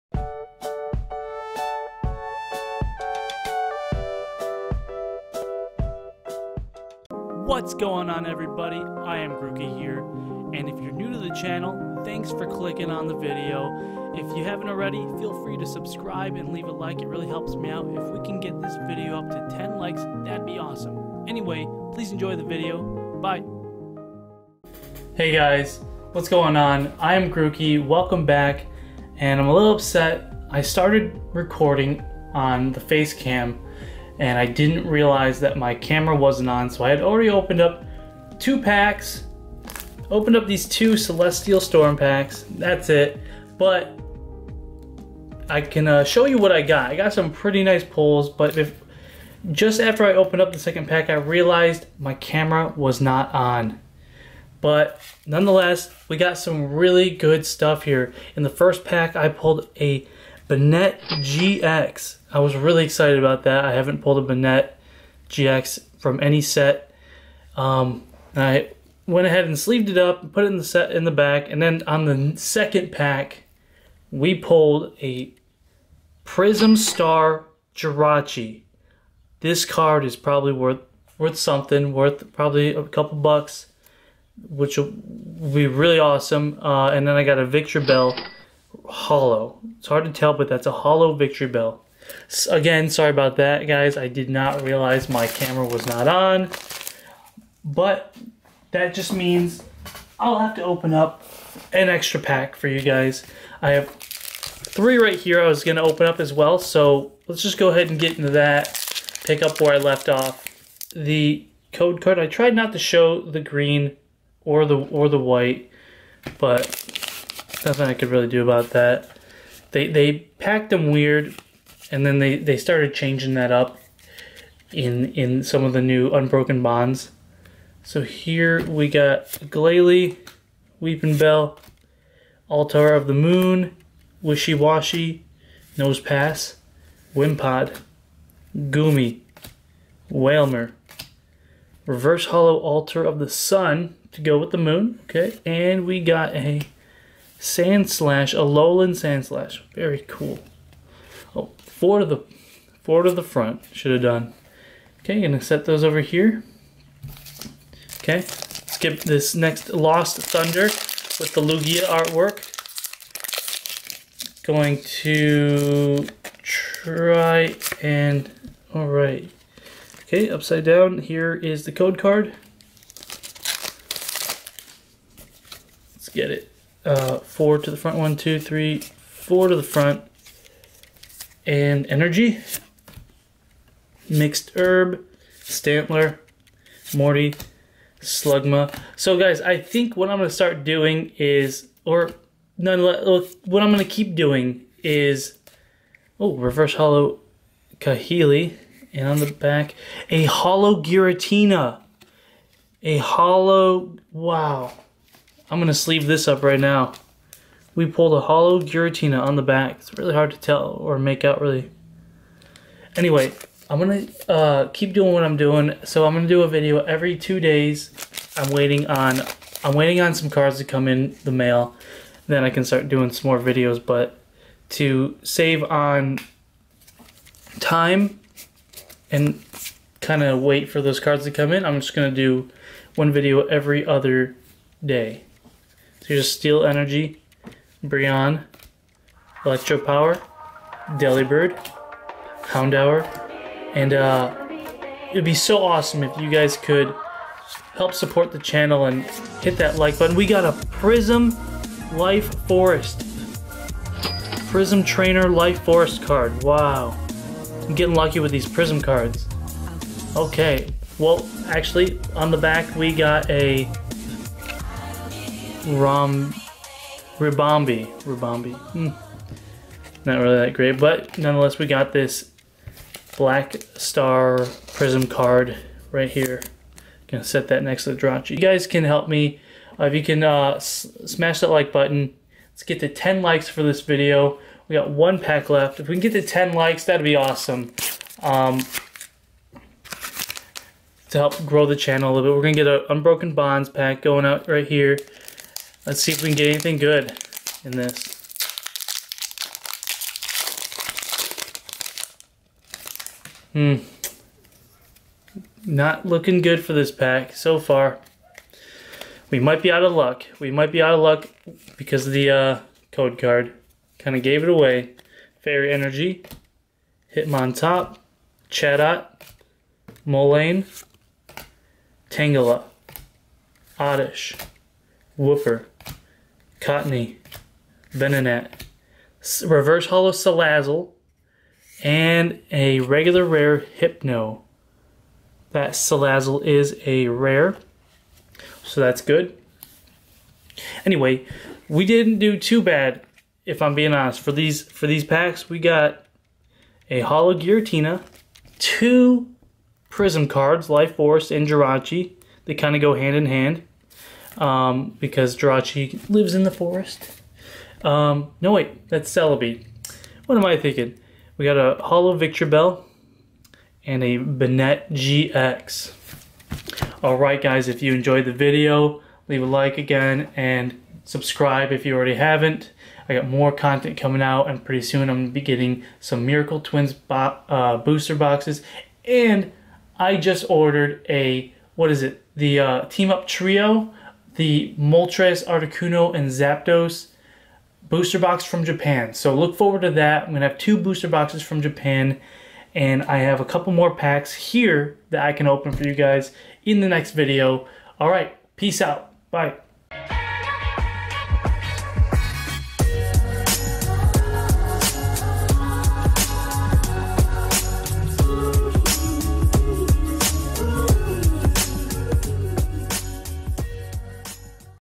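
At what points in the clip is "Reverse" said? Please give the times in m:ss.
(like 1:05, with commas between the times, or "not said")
2:21, 3:16, 5:29.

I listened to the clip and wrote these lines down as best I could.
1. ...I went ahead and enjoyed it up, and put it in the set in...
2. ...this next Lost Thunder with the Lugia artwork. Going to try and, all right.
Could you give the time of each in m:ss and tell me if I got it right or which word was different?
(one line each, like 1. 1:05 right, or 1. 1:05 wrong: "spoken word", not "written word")
1. 1:08 wrong: "sleeved", not "enjoyed"
2. 2:38 right.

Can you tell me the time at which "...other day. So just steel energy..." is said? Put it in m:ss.
3:53.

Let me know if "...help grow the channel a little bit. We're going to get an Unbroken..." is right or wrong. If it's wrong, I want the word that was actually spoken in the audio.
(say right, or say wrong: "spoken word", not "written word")
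right.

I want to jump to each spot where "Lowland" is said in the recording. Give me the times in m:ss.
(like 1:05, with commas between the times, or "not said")
2:28.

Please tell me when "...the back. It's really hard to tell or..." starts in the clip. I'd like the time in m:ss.
3:29.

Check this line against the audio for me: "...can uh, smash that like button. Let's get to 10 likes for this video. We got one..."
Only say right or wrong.
right.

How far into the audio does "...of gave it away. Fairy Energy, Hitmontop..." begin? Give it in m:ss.
5:14.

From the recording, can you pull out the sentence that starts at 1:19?
This card is probably worth worth something, worth probably a couple bucks, which will be really awesome.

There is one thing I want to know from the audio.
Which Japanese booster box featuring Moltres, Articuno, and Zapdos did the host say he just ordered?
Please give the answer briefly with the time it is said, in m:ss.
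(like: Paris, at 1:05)
Team Up, at 6:22.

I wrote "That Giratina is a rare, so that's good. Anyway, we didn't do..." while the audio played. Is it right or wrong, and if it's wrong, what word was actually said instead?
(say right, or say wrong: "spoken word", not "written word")
wrong: "Salazzle", not "Giratina".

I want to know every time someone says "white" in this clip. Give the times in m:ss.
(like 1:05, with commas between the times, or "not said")
1:55.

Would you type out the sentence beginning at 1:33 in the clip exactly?
I did not realize my camera was not on.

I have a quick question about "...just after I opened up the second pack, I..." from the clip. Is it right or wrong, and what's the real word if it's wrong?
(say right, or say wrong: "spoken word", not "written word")
right.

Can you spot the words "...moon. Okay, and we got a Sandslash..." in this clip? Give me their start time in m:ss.
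2:24.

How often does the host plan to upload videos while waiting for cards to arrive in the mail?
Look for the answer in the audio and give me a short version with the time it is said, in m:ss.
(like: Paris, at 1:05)
every two days, at 3:36.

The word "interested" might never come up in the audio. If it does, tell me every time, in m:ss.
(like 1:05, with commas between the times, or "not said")
not said.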